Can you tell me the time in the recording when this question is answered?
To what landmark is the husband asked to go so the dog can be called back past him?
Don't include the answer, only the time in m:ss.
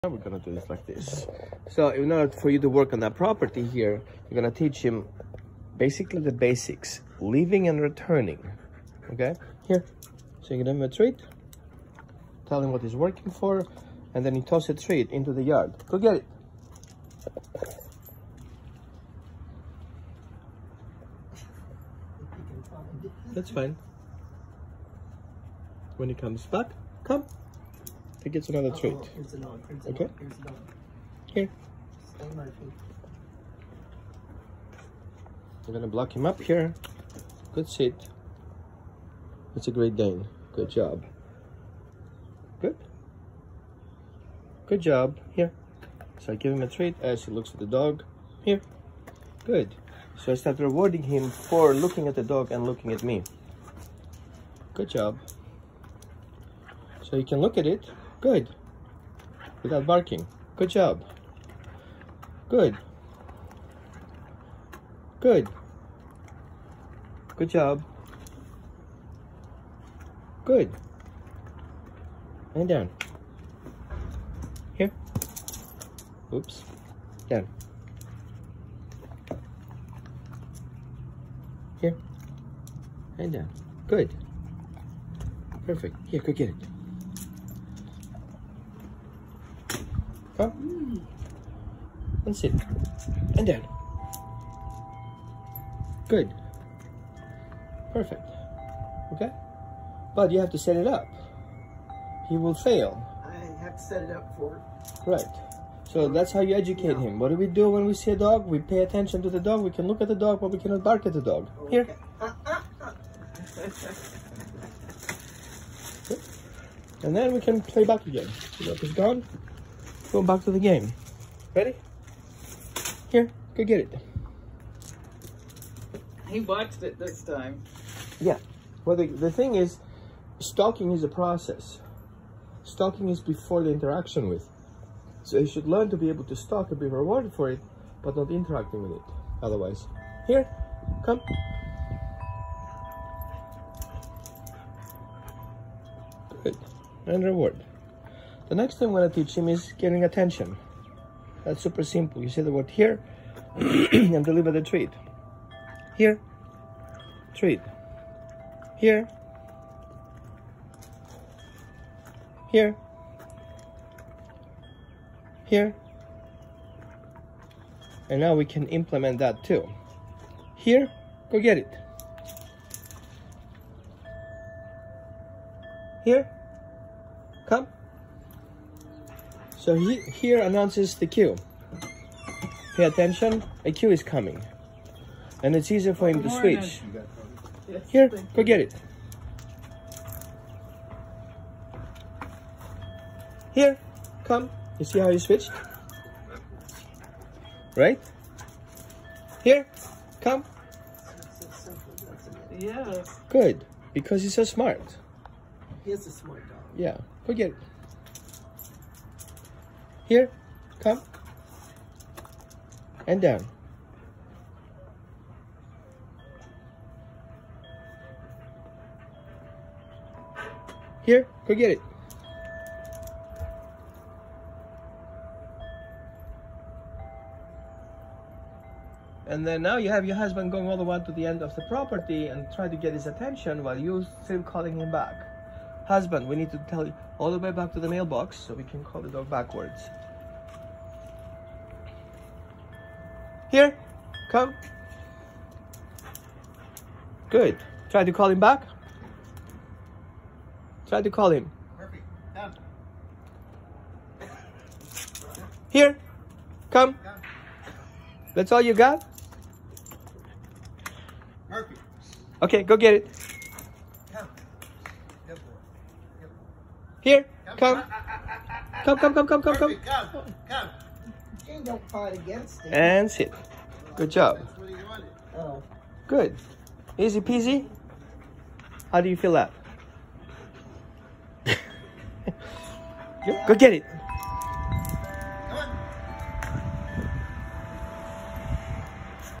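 3:57.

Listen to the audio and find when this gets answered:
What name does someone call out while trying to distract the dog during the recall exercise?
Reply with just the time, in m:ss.
4:21.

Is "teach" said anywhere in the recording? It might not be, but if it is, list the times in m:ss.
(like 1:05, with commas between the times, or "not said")
0:04, 2:29.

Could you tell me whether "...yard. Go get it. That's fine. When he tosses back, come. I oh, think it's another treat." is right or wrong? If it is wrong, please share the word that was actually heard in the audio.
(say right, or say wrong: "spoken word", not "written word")
wrong: "comes", not "tosses".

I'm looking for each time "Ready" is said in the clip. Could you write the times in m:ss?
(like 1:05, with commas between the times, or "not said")
2:01.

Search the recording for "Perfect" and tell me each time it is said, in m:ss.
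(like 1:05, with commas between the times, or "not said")
1:25, 1:37.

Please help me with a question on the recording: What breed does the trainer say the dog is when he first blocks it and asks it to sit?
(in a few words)
Great Dane.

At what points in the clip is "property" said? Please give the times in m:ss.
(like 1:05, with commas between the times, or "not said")
0:03, 3:51.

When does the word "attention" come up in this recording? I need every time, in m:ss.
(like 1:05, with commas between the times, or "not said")
1:48, 2:30, 3:02, 3:53.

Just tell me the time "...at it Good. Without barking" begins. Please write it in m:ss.
0:57.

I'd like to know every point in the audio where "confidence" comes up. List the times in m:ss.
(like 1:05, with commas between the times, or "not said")
not said.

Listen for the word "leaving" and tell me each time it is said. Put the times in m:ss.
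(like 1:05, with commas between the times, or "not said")
0:07.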